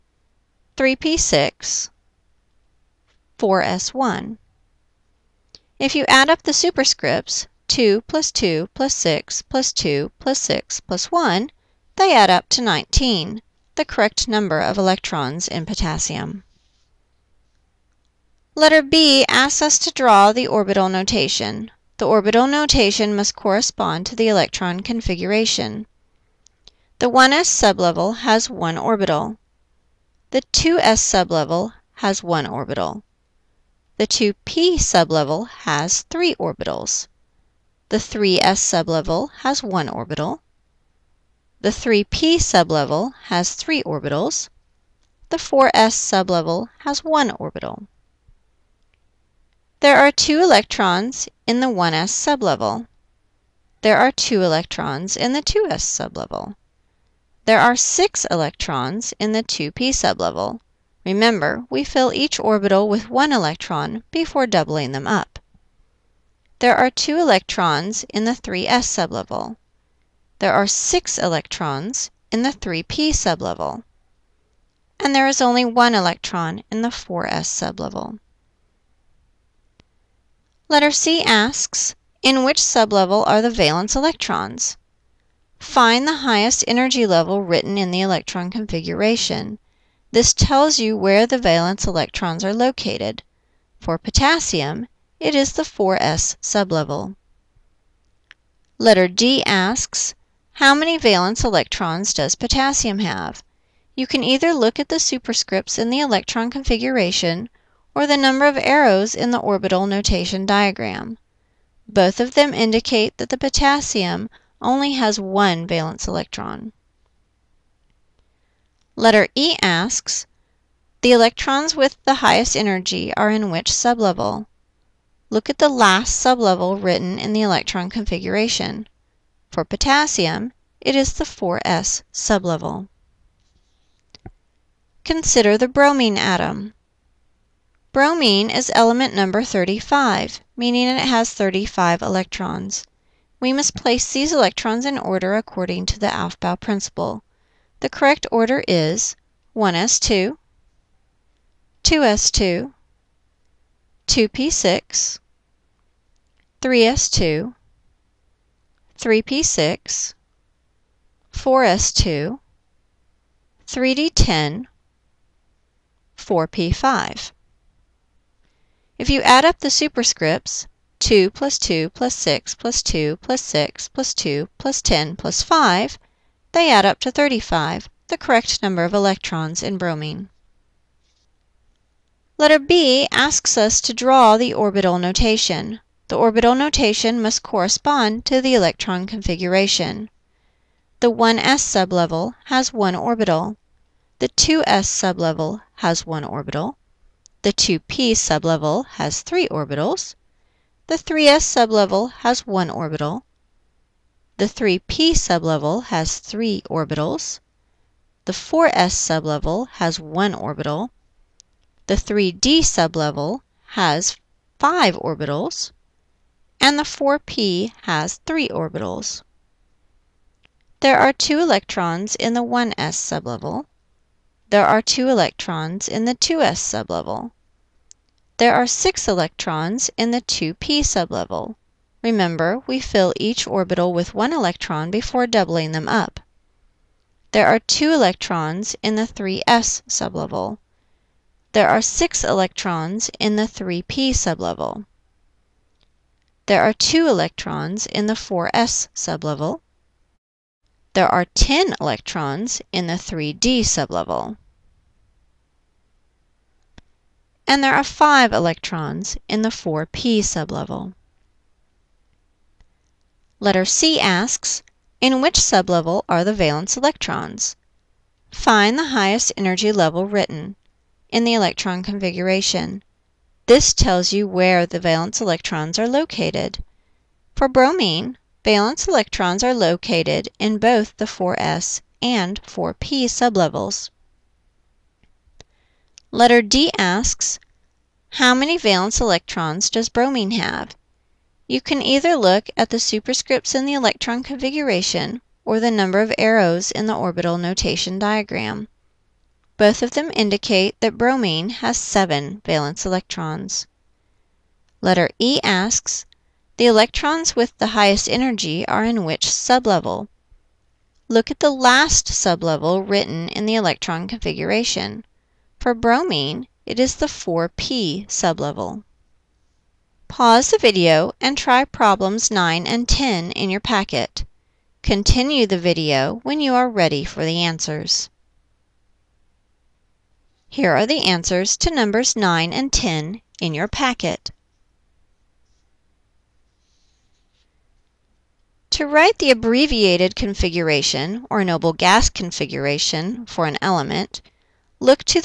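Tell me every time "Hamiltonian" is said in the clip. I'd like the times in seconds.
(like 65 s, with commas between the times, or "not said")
not said.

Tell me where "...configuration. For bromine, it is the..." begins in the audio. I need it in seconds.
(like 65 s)
314 s.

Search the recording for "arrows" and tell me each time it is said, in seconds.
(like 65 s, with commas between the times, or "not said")
108 s, 296 s.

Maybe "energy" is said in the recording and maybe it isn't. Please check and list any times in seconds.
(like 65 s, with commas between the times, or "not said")
86 s, 122 s, 269 s, 308 s.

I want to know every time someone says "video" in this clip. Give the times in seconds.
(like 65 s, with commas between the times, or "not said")
320 s, 325 s.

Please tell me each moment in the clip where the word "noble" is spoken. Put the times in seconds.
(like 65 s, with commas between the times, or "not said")
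341 s.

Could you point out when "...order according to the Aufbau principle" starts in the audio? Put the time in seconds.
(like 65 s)
144 s.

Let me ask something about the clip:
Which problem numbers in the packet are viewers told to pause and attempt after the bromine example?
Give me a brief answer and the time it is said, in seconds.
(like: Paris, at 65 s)
9 and 10, at 321 s.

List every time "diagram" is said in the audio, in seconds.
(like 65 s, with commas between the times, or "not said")
110 s, 297 s.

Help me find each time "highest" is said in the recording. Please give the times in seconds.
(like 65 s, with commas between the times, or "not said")
86 s, 122 s, 268 s, 307 s.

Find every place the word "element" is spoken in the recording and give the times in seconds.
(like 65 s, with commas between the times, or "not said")
138 s, 343 s.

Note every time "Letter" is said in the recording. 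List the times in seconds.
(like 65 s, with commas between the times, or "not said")
18 s, 80 s, 98 s, 119 s, 182 s, 263 s, 286 s, 304 s.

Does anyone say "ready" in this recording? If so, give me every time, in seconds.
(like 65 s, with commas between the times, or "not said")
326 s.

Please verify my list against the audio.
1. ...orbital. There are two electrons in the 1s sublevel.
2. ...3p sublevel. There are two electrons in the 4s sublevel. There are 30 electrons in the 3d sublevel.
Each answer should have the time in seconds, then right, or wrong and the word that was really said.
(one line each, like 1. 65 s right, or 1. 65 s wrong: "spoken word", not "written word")
1. 47 s right
2. 243 s wrong: "10", not "30".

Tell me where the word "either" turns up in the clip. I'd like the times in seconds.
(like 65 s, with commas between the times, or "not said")
104 s, 291 s.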